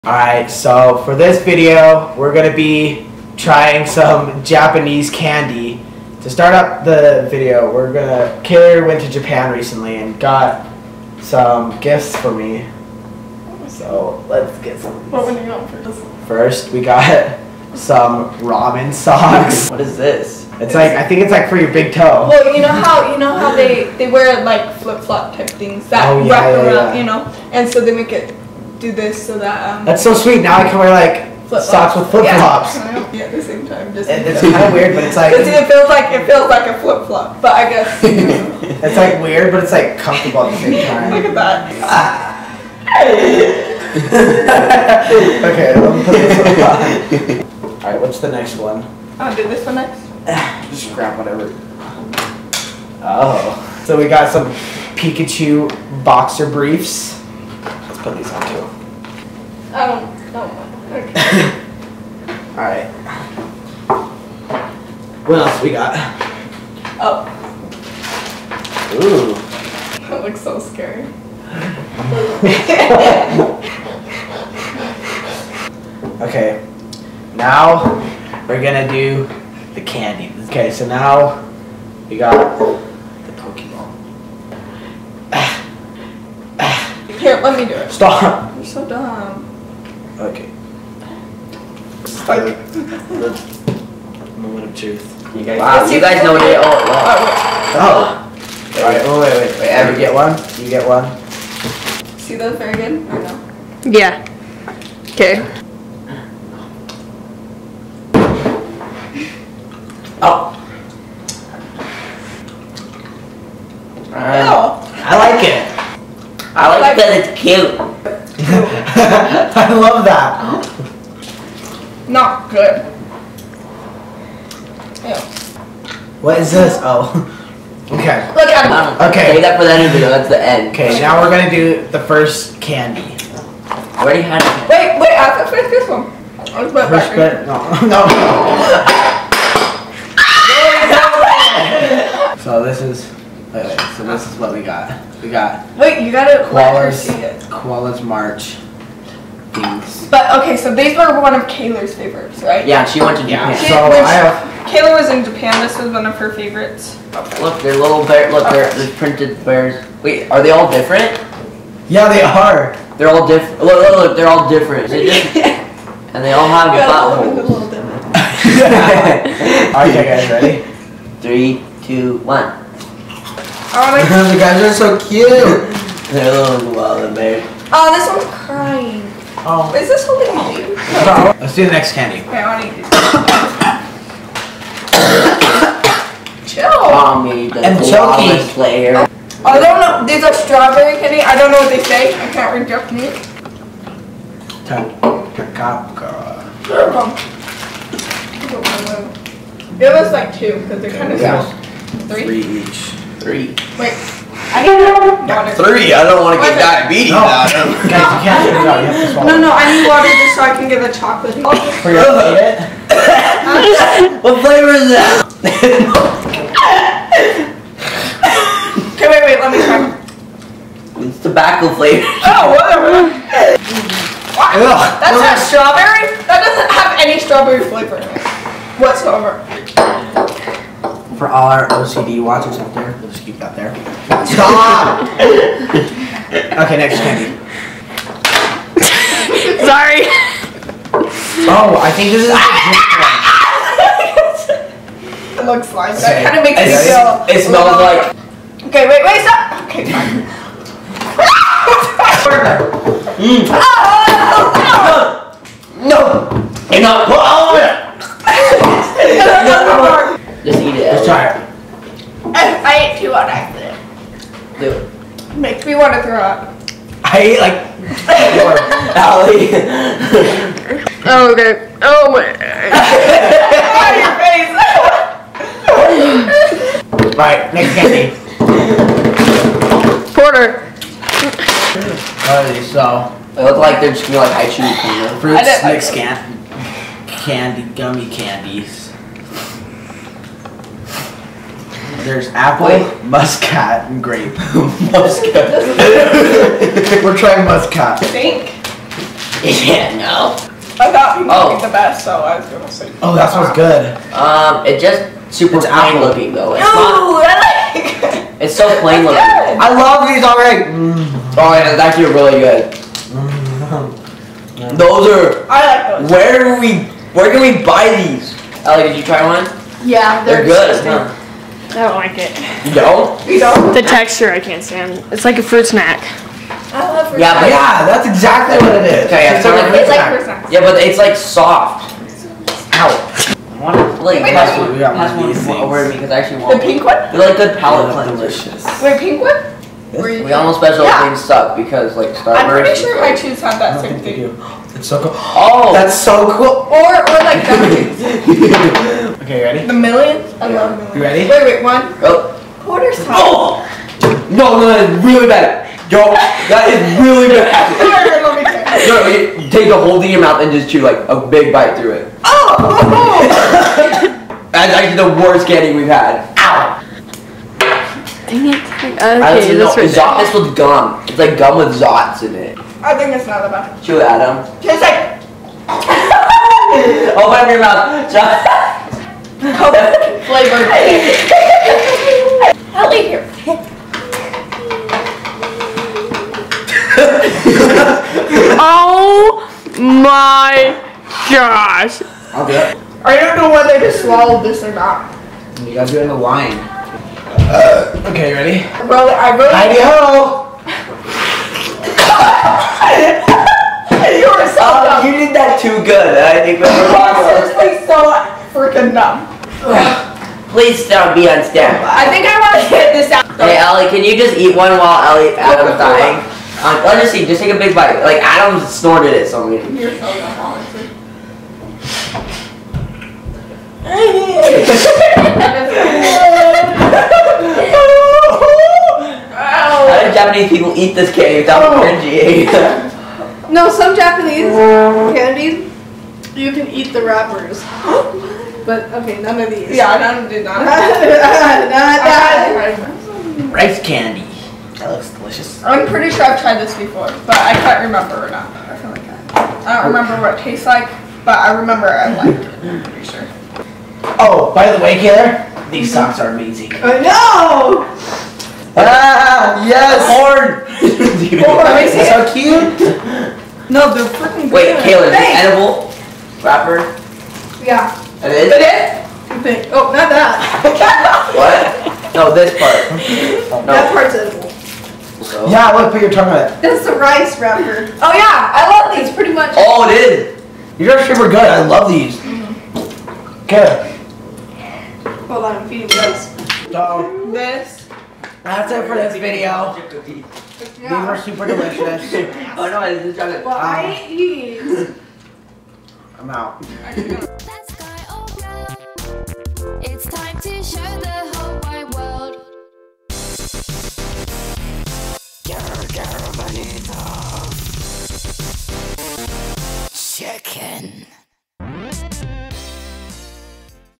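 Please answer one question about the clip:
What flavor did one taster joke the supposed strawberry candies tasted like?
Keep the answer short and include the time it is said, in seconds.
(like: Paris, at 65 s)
tobacco, at 221 s.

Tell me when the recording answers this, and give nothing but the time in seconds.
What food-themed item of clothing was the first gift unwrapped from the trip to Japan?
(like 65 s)
18 s.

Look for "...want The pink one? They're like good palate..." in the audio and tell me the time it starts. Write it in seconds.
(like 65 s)
336 s.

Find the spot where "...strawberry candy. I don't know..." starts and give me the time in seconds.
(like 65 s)
190 s.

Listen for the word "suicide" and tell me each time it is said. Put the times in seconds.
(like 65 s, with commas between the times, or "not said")
not said.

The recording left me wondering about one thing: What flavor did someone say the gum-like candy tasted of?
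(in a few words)
coconut.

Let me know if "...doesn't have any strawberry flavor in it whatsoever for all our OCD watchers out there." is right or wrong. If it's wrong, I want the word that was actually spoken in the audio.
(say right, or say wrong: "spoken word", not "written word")
right.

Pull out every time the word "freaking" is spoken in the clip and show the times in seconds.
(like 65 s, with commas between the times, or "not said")
408 s, 464 s.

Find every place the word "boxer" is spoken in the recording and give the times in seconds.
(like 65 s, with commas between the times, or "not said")
56 s.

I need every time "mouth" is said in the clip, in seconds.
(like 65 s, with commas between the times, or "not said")
360 s, 377 s.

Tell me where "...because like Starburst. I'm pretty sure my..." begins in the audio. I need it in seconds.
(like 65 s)
341 s.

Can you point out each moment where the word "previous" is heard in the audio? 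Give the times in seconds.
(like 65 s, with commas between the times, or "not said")
not said.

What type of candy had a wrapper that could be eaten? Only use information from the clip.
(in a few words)
rice candy.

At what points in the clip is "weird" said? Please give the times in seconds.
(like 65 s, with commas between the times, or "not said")
34 s, 39 s.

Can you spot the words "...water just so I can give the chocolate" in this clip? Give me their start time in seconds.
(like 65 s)
209 s.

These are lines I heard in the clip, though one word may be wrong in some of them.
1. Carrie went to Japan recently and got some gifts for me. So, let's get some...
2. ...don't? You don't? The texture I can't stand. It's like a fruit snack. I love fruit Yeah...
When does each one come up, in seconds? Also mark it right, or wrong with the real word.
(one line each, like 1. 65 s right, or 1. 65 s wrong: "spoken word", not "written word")
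1. 8 s right
2. 322 s right.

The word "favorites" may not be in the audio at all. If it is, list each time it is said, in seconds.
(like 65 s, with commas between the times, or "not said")
151 s, 156 s.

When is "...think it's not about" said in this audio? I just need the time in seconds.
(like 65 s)
372 s.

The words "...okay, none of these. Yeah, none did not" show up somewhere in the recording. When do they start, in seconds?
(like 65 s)
439 s.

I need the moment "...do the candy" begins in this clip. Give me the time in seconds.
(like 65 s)
78 s.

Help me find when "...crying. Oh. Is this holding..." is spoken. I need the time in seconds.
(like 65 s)
178 s.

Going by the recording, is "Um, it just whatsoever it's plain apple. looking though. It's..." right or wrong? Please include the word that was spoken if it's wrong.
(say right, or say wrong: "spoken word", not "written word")
wrong: "super", not "whatsoever".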